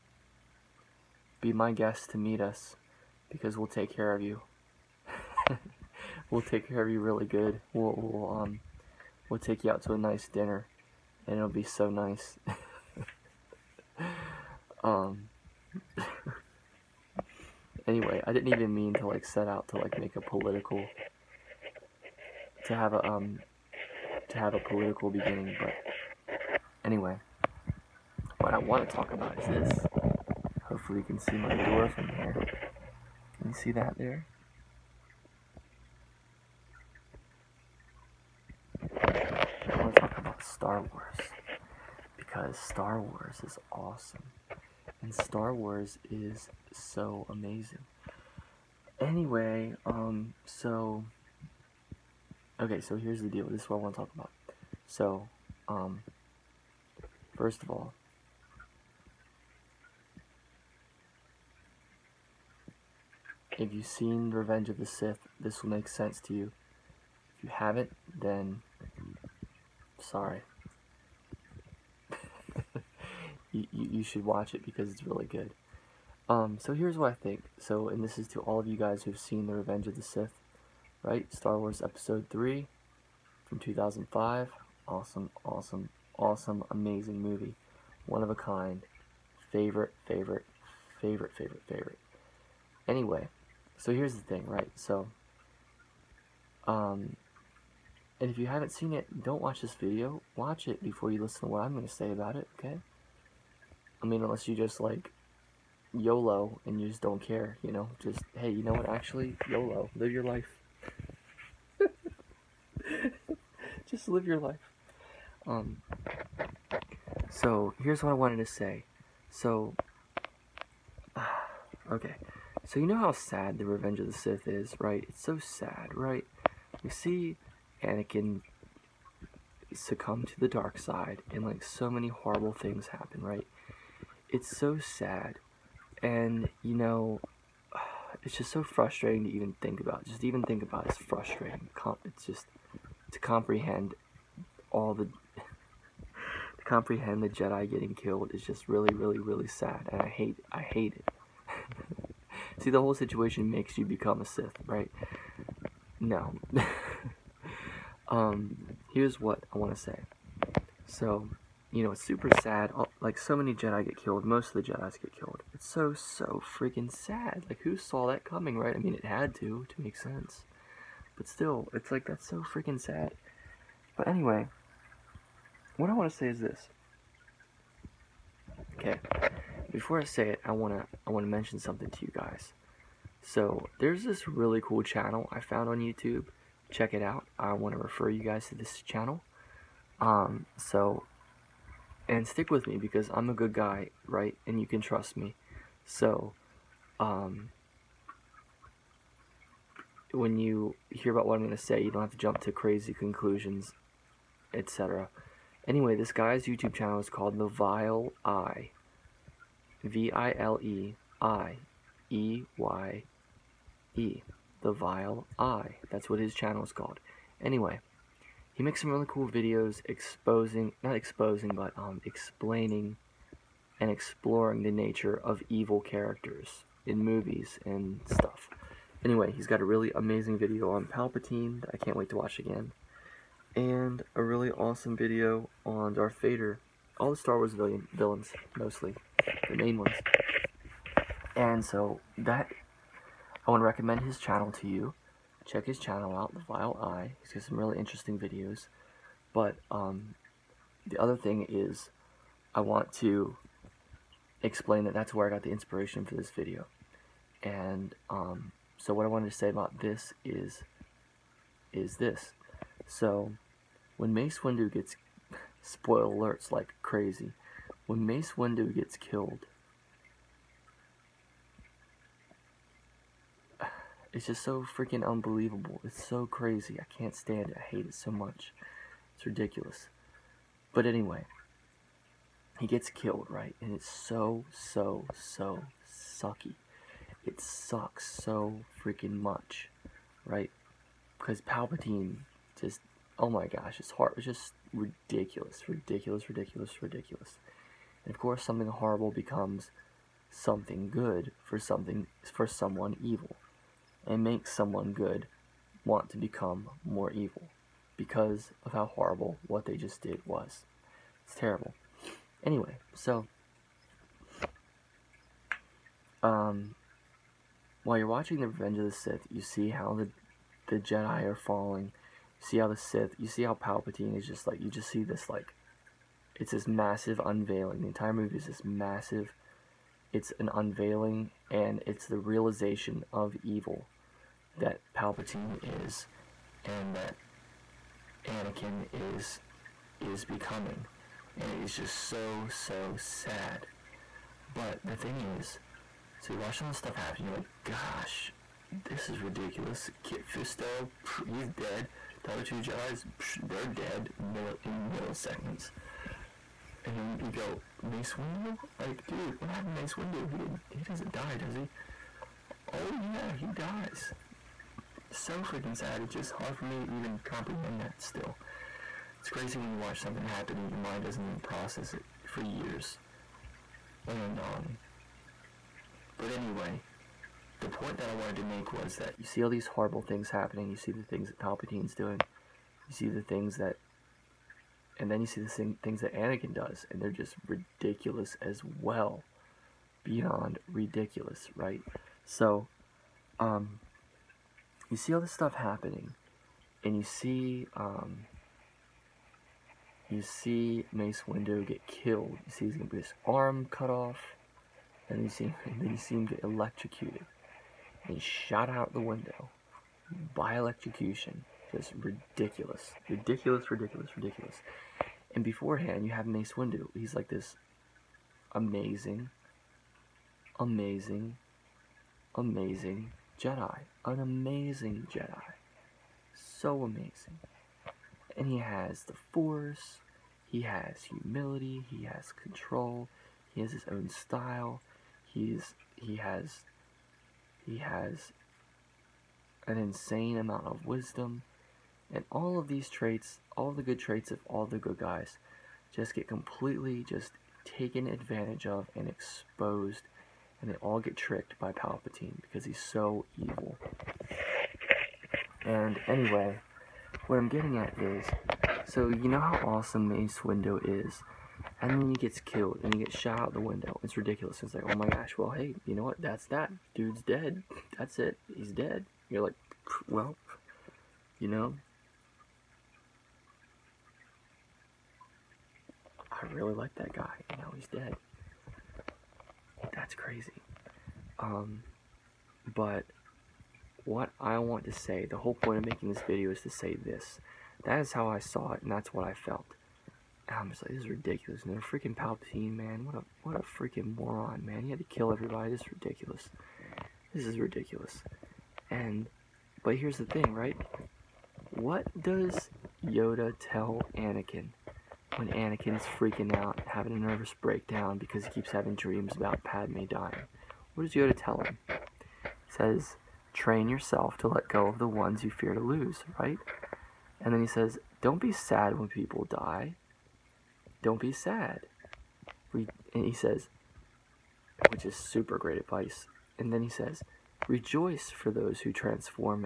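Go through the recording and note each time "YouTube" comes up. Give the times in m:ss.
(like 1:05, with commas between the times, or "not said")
3:05, 3:26.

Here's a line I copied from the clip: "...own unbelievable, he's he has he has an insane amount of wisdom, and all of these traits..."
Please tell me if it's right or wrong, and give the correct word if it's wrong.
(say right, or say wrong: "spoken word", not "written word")
wrong: "style", not "unbelievable".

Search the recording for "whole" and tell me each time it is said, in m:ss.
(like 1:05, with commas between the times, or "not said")
2:32, 8:05.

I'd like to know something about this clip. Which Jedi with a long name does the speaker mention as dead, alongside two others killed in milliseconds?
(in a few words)
Kit Fisto.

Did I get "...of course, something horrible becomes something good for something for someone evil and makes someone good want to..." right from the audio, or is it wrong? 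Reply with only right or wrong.
right.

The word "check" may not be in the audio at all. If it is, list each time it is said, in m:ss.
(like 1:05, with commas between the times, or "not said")
3:06, 4:05.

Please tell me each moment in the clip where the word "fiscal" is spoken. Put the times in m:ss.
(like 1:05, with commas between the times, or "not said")
not said.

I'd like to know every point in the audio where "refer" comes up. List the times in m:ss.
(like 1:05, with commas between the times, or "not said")
3:07.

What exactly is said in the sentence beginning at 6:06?
It's just hard for me to even comprehend that still.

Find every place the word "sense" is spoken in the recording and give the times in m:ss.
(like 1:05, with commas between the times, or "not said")
1:05, 2:49.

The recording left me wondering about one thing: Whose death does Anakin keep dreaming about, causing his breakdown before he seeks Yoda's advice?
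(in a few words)
Padme.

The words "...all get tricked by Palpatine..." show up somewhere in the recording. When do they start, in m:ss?
7:30.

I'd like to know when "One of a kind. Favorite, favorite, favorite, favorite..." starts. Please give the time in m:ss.
1:28.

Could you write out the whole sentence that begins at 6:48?
And shot out the window by electrocution.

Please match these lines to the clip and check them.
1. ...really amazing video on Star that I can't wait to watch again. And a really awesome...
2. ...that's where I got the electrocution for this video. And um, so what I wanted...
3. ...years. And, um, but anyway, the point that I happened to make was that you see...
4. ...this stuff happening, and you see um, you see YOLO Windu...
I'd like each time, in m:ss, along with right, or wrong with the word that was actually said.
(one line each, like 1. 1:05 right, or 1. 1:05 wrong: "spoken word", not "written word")
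1. 3:49 wrong: "Palpatine", not "Star"
2. 4:14 wrong: "inspiration", not "electrocution"
3. 6:12 wrong: "wanted", not "happened"
4. 6:35 wrong: "Mace", not "YOLO".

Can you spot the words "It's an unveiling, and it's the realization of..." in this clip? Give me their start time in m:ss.
5:30.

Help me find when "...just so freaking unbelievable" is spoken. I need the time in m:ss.
4:34.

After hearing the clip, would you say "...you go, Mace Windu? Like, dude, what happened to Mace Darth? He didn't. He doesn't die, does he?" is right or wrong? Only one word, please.
wrong.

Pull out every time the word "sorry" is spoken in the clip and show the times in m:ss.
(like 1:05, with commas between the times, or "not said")
1:09.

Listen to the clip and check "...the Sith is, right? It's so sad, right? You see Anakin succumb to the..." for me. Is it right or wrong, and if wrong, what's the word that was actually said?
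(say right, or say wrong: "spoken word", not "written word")
right.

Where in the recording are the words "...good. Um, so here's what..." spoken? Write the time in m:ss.
1:15.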